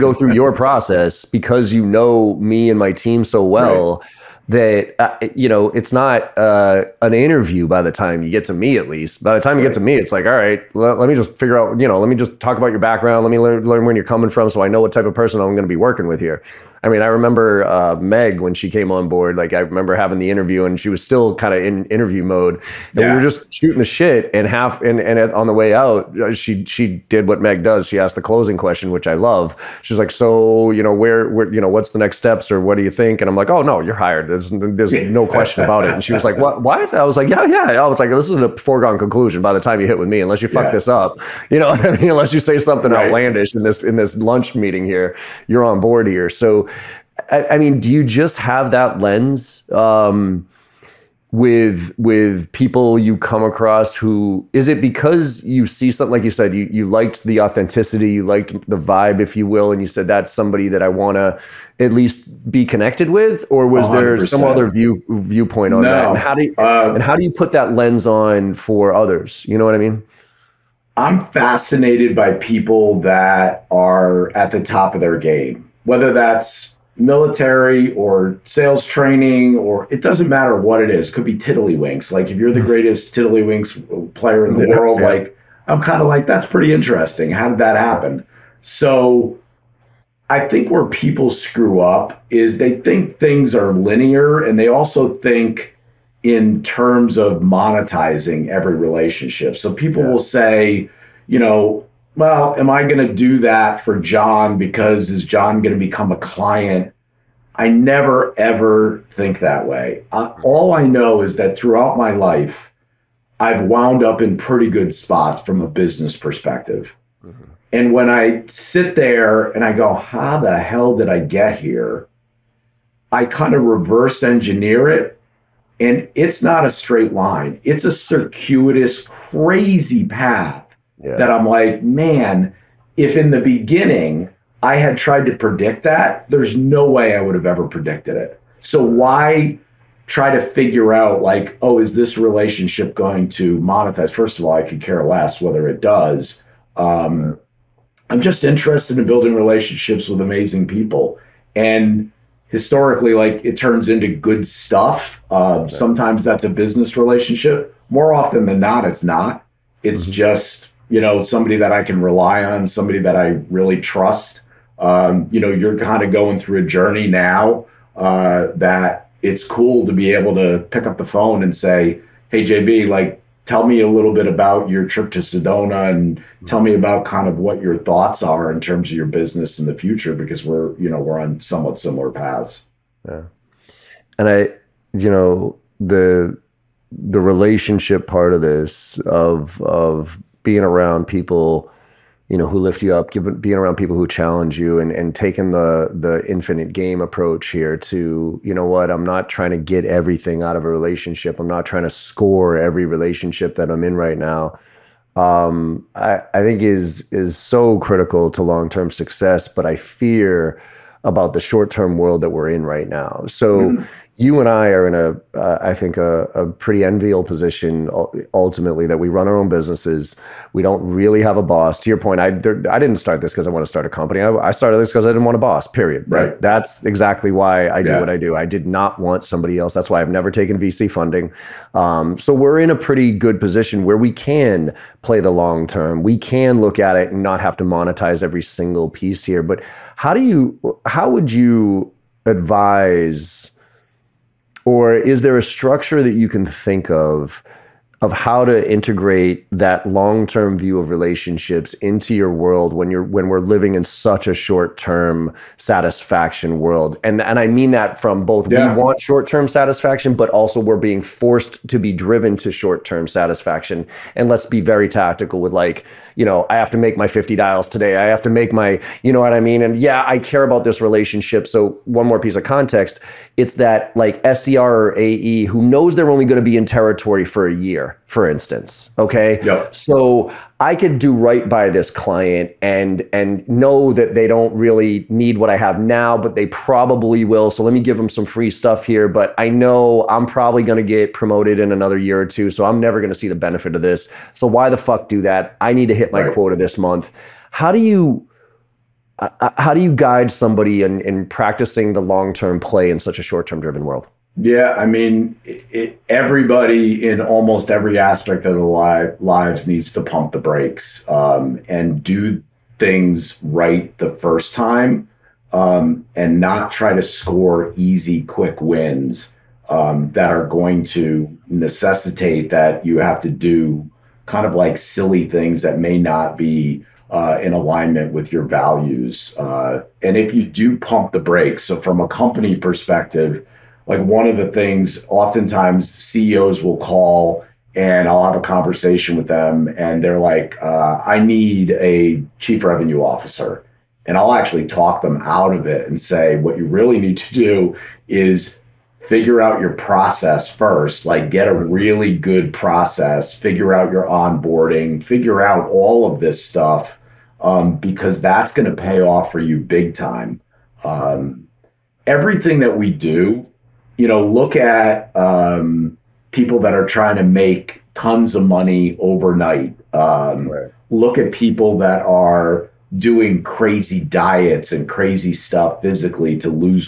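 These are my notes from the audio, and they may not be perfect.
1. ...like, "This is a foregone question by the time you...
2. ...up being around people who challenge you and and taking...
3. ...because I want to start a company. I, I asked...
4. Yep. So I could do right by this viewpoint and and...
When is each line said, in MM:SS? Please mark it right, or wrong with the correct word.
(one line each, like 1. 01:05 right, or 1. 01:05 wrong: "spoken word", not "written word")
1. 00:37 wrong: "conclusion", not "question"
2. 03:12 right
3. 03:43 wrong: "started", not "asked"
4. 04:39 wrong: "client", not "viewpoint".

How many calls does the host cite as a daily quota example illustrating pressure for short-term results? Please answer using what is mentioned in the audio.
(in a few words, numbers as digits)
50.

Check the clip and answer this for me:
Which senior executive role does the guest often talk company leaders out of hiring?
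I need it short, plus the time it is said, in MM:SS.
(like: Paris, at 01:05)
Chief revenue officer, at 05:42.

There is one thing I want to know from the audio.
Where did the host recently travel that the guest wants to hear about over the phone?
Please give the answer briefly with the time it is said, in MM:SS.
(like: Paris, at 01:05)
Sedona, at 02:55.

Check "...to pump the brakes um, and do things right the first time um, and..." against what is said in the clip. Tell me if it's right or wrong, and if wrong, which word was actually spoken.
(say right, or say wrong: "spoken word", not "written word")
right.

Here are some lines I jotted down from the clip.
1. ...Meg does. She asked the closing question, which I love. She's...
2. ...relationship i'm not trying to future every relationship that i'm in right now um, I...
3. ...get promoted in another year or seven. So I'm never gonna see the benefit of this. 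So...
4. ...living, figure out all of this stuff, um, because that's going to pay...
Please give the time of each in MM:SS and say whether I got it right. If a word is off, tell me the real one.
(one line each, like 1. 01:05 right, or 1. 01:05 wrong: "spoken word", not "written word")
1. 00:27 right
2. 03:20 wrong: "score", not "future"
3. 04:50 wrong: "two", not "seven"
4. 05:54 wrong: "onboarding", not "living".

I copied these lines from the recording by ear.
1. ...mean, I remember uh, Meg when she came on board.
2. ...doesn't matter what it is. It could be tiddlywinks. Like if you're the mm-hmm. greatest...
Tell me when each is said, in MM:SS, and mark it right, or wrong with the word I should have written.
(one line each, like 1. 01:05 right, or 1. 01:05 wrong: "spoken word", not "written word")
1. 00:16 right
2. 01:20 right.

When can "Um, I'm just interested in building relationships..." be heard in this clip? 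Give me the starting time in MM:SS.
02:26.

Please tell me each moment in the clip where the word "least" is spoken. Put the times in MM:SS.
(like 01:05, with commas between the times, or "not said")
00:08, 01:01.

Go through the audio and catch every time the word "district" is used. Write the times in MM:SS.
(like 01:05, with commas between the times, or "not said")
not said.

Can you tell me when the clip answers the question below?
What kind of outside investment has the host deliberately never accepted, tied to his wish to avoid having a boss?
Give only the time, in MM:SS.
03:50.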